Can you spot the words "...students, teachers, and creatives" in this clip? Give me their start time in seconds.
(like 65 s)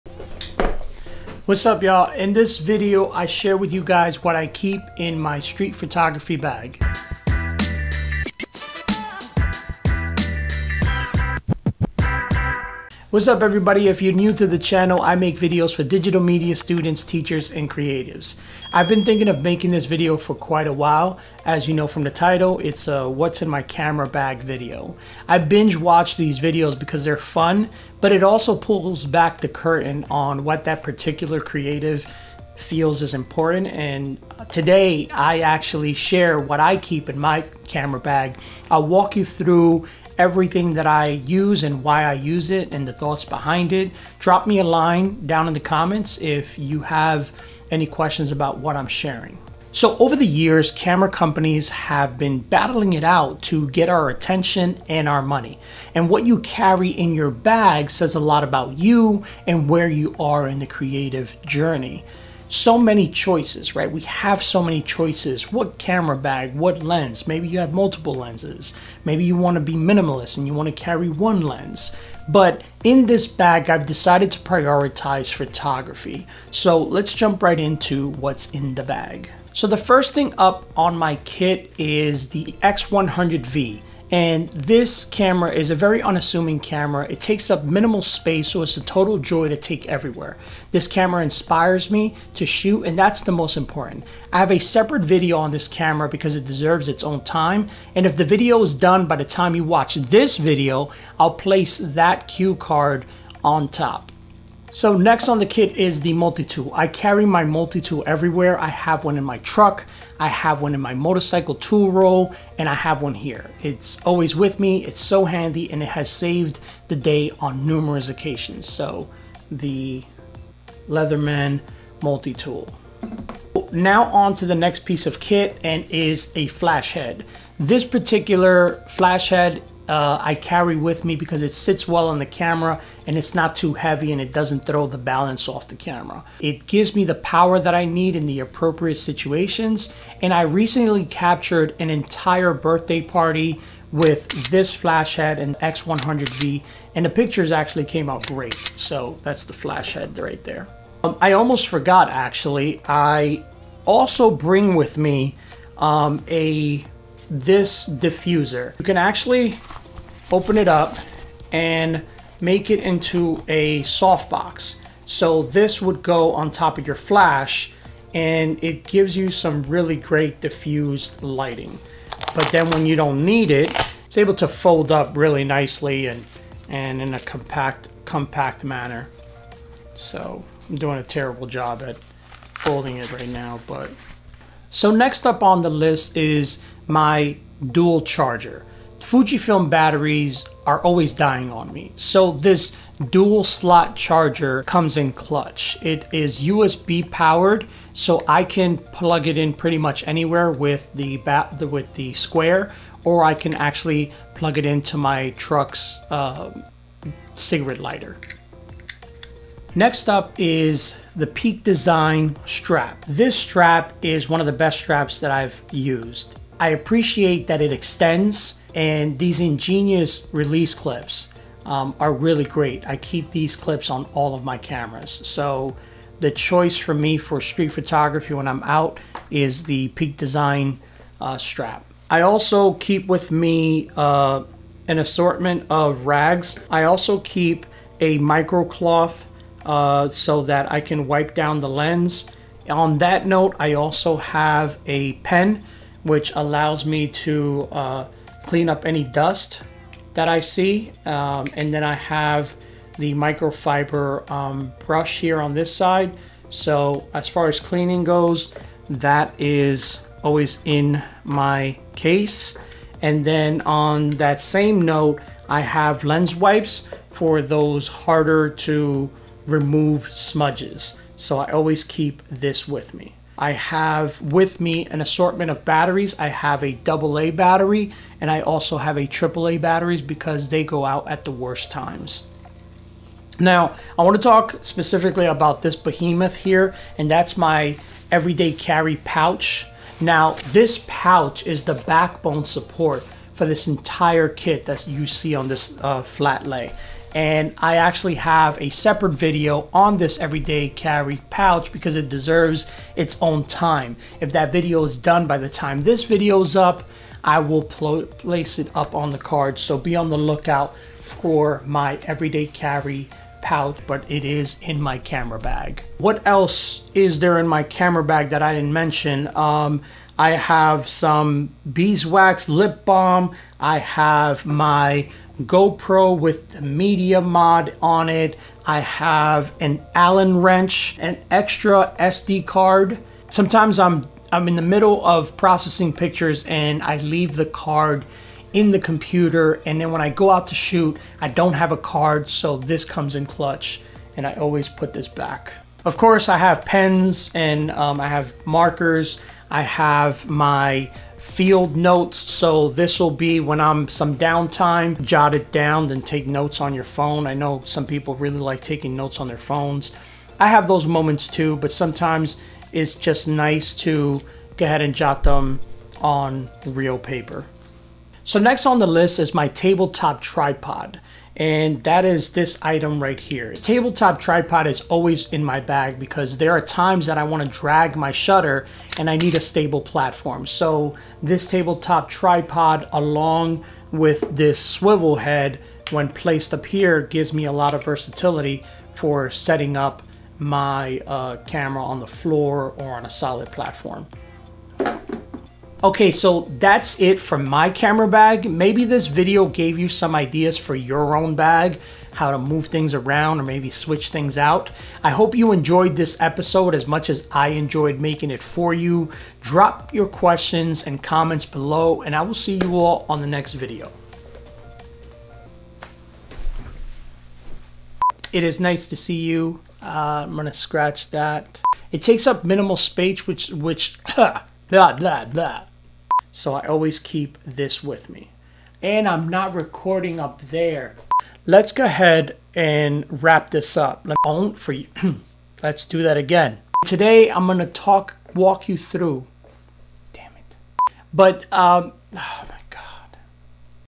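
16 s.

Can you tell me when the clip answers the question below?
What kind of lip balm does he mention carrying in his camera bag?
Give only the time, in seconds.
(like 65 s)
321 s.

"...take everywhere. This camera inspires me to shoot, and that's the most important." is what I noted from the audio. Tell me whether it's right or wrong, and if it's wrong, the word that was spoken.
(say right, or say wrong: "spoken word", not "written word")
right.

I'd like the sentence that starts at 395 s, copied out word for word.
Okay, so that's it from my camera bag.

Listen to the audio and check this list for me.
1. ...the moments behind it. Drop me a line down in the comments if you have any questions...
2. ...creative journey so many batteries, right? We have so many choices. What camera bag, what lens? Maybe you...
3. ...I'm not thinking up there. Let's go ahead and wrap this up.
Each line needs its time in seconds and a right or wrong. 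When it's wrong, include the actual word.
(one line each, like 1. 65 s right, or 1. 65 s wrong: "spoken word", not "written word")
1. 42 s wrong: "thoughts", not "moments"
2. 60 s wrong: "choices", not "batteries"
3. 429 s wrong: "recording", not "thinking".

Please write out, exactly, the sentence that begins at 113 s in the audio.
It's always with me, it's so handy, and it has saved the day on numerous occasions.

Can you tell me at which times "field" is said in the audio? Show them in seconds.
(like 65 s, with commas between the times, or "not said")
351 s.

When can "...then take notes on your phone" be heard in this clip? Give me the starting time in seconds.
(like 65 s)
355 s.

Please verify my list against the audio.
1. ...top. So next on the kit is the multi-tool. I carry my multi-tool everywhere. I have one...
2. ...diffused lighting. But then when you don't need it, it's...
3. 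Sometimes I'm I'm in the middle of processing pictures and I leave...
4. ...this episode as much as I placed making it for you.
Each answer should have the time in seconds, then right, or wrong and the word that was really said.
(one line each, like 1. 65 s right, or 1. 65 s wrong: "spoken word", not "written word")
1. 103 s right
2. 170 s right
3. 333 s right
4. 405 s wrong: "enjoyed", not "placed".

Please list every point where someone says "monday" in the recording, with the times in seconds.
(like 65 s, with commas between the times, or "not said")
not said.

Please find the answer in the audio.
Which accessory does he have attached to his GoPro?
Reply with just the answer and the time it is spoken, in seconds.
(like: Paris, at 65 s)
media mod, at 326 s.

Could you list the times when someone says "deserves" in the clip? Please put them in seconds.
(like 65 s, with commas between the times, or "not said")
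96 s, 302 s.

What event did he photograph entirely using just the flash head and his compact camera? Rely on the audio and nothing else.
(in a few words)
birthday party.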